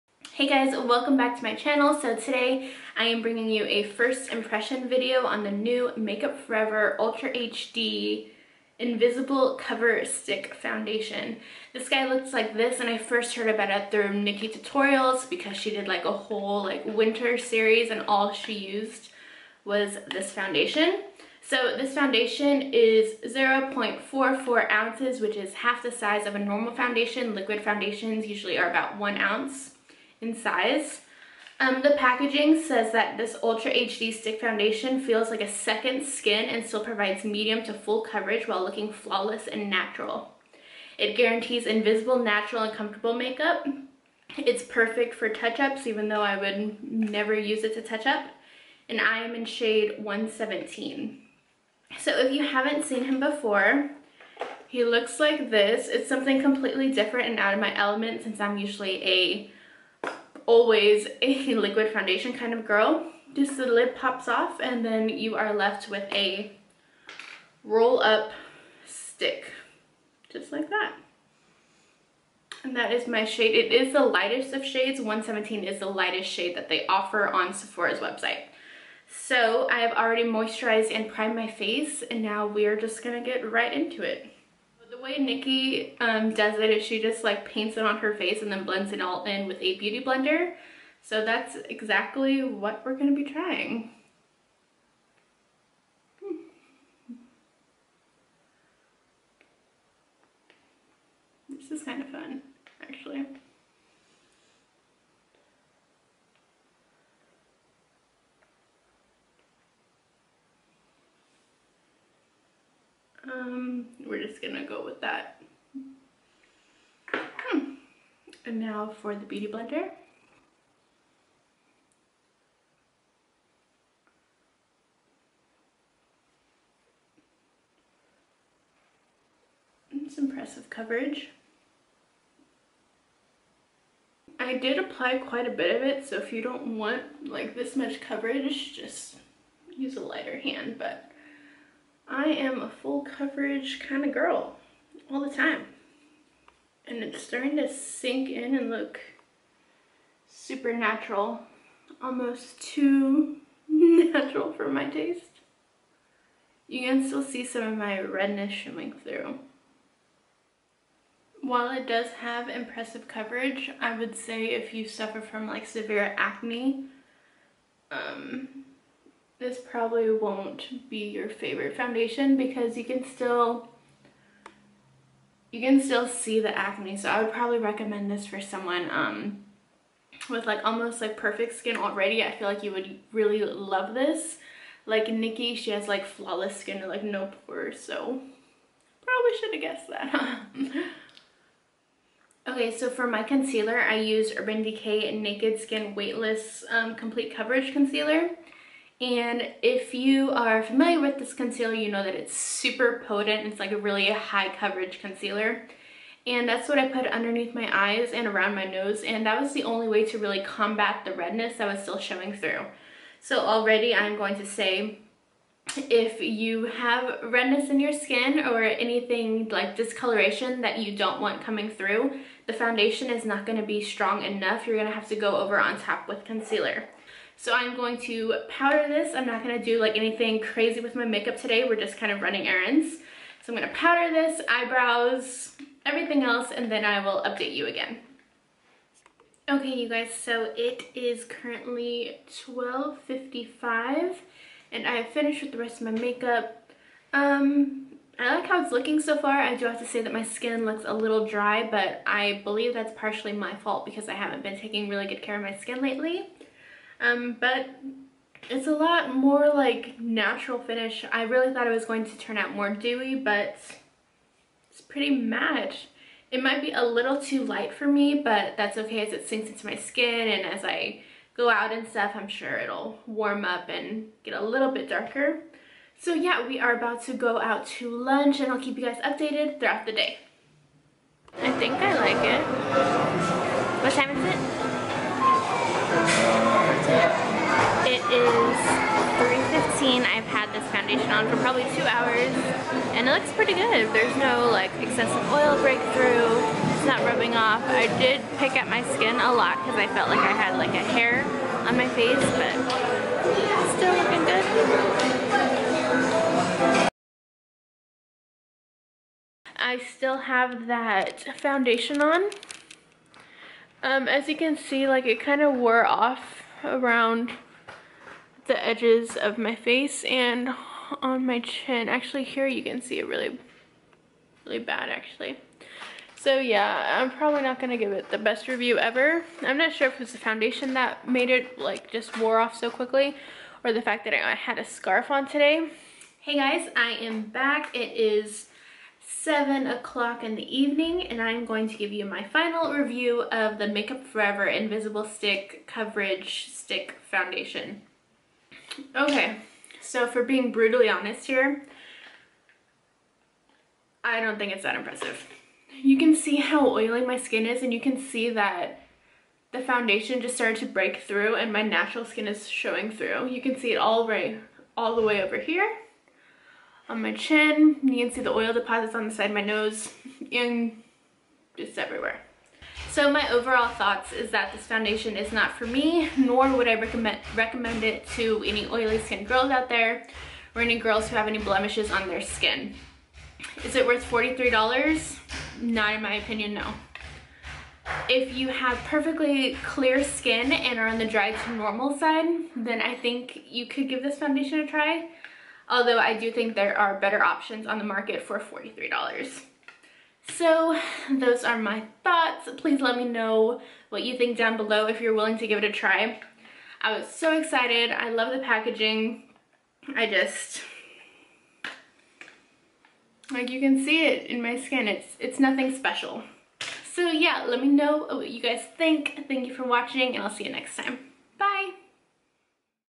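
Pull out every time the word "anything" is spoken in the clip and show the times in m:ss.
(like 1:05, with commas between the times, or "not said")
3:38, 3:49.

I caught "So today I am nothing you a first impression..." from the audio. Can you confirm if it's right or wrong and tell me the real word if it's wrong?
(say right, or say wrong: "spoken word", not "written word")
wrong: "bringing", not "nothing".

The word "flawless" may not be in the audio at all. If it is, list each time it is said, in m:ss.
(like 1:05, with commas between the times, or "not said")
0:38, 3:06.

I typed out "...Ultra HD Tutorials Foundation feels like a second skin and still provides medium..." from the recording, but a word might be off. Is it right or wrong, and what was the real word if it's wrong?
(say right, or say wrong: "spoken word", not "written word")
wrong: "Stick", not "Tutorials".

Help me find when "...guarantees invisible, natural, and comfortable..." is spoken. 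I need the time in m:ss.
0:41.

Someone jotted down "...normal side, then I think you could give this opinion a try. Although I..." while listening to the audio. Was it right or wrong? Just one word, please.
wrong.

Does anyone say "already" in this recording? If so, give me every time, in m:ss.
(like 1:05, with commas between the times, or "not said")
1:19, 3:01, 3:33.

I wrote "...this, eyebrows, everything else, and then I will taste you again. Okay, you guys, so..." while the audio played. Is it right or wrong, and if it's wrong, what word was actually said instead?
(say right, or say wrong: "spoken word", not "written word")
wrong: "update", not "taste".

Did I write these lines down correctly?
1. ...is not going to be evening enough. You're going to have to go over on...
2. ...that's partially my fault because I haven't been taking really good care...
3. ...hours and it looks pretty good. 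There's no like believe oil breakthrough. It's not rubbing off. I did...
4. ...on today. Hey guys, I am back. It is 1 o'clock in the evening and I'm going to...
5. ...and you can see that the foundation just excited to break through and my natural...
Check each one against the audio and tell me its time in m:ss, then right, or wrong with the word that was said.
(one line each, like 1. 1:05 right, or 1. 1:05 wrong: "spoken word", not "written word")
1. 3:43 wrong: "strong", not "evening"
2. 4:12 right
3. 4:51 wrong: "excessive", not "believe"
4. 5:35 wrong: "7", not "1"
5. 5:57 wrong: "started", not "excited".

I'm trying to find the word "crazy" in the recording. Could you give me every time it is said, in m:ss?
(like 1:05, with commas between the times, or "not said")
3:50.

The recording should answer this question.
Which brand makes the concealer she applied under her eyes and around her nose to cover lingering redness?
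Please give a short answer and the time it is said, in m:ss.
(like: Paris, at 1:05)
Urban Decay, at 3:14.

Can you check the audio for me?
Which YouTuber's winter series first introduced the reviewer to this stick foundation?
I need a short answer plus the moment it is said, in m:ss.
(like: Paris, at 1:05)
Nikkie Tutorials, at 0:14.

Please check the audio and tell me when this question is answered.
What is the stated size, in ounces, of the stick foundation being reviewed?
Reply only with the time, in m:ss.
0:23.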